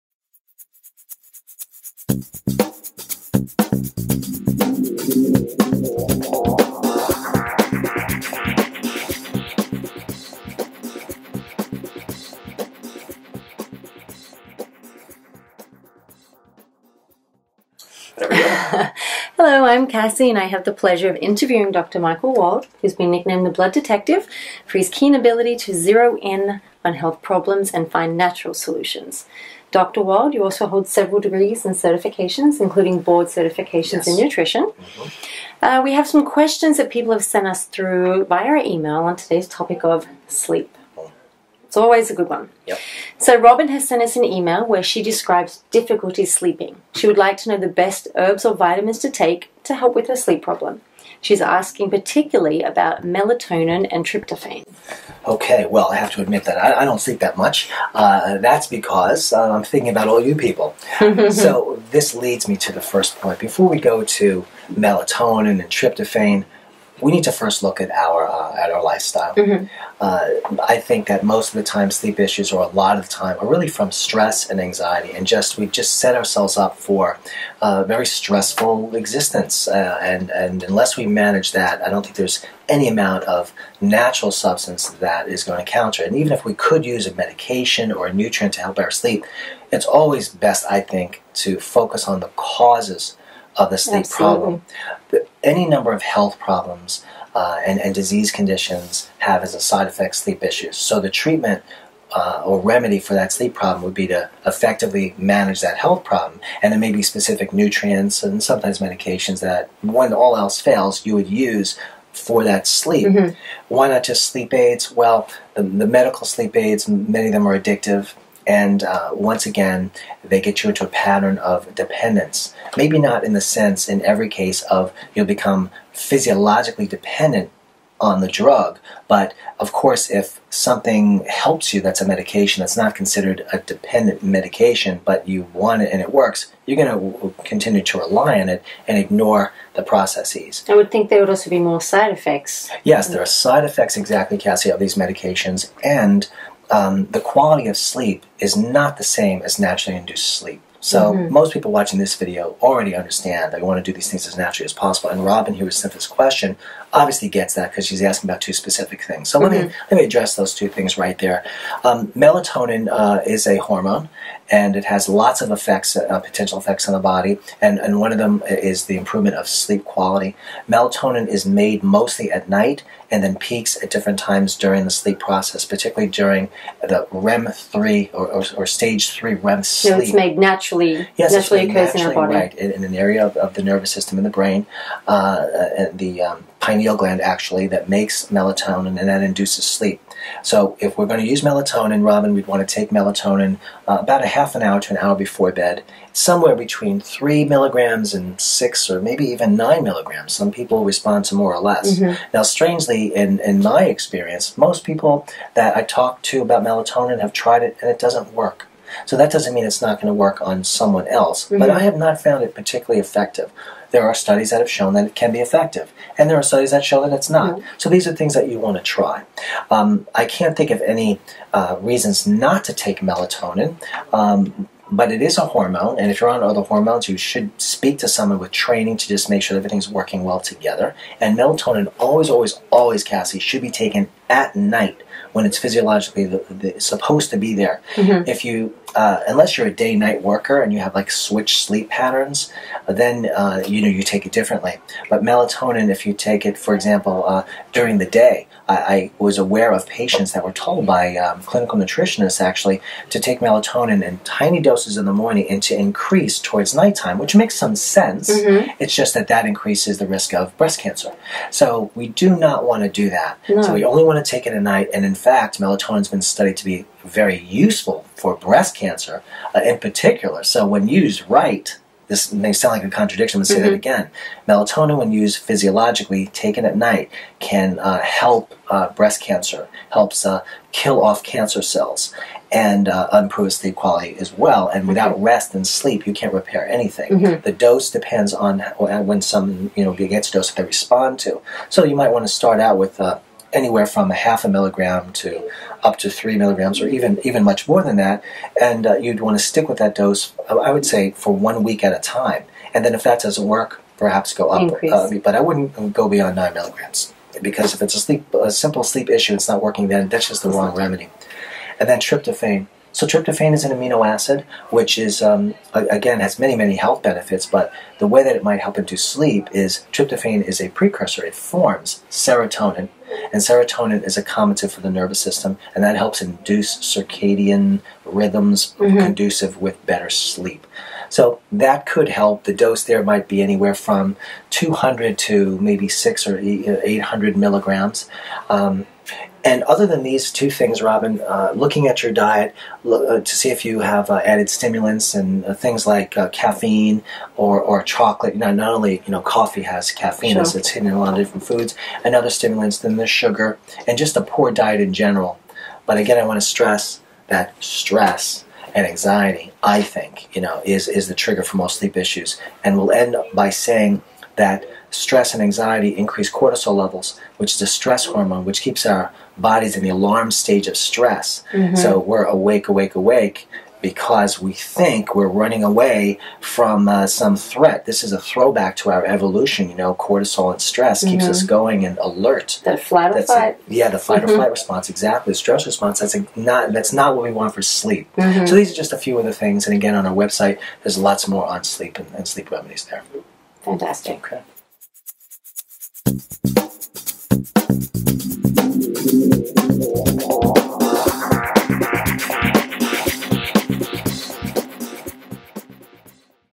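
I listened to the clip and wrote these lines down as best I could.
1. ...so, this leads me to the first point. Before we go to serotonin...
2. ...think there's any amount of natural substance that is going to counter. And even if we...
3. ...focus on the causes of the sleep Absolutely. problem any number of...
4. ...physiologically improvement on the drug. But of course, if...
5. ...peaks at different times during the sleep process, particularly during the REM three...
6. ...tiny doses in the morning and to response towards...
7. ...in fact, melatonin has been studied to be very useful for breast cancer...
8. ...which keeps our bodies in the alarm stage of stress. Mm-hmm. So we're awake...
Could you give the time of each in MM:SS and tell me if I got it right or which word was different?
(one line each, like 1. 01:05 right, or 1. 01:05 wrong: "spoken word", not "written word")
1. 01:01 wrong: "melatonin", not "serotonin"
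2. 01:22 right
3. 01:31 right
4. 02:05 wrong: "dependent", not "improvement"
5. 02:53 right
6. 04:14 wrong: "increase", not "response"
7. 04:25 right
8. 06:08 right.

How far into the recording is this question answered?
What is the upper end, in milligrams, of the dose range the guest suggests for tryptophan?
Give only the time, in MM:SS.
05:36.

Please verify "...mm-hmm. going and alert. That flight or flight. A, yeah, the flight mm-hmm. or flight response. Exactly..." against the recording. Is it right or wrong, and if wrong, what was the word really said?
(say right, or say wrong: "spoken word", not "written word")
right.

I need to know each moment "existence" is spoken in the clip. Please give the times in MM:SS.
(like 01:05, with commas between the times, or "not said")
01:19.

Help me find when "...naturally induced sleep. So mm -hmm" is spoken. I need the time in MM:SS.
02:29.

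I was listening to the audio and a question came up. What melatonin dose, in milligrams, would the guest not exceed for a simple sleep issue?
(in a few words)
9 milligrams.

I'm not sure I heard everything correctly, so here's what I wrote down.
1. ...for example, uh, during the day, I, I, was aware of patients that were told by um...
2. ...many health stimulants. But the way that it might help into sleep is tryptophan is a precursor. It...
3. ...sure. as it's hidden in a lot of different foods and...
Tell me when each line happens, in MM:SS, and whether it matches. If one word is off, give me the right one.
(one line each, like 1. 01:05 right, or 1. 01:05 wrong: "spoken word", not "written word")
1. 04:06 right
2. 05:16 wrong: "benefits", not "stimulants"
3. 05:50 right.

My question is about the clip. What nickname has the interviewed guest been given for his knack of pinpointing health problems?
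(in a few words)
The Blood Detective.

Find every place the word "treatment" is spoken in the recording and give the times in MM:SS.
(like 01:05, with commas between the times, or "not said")
01:41.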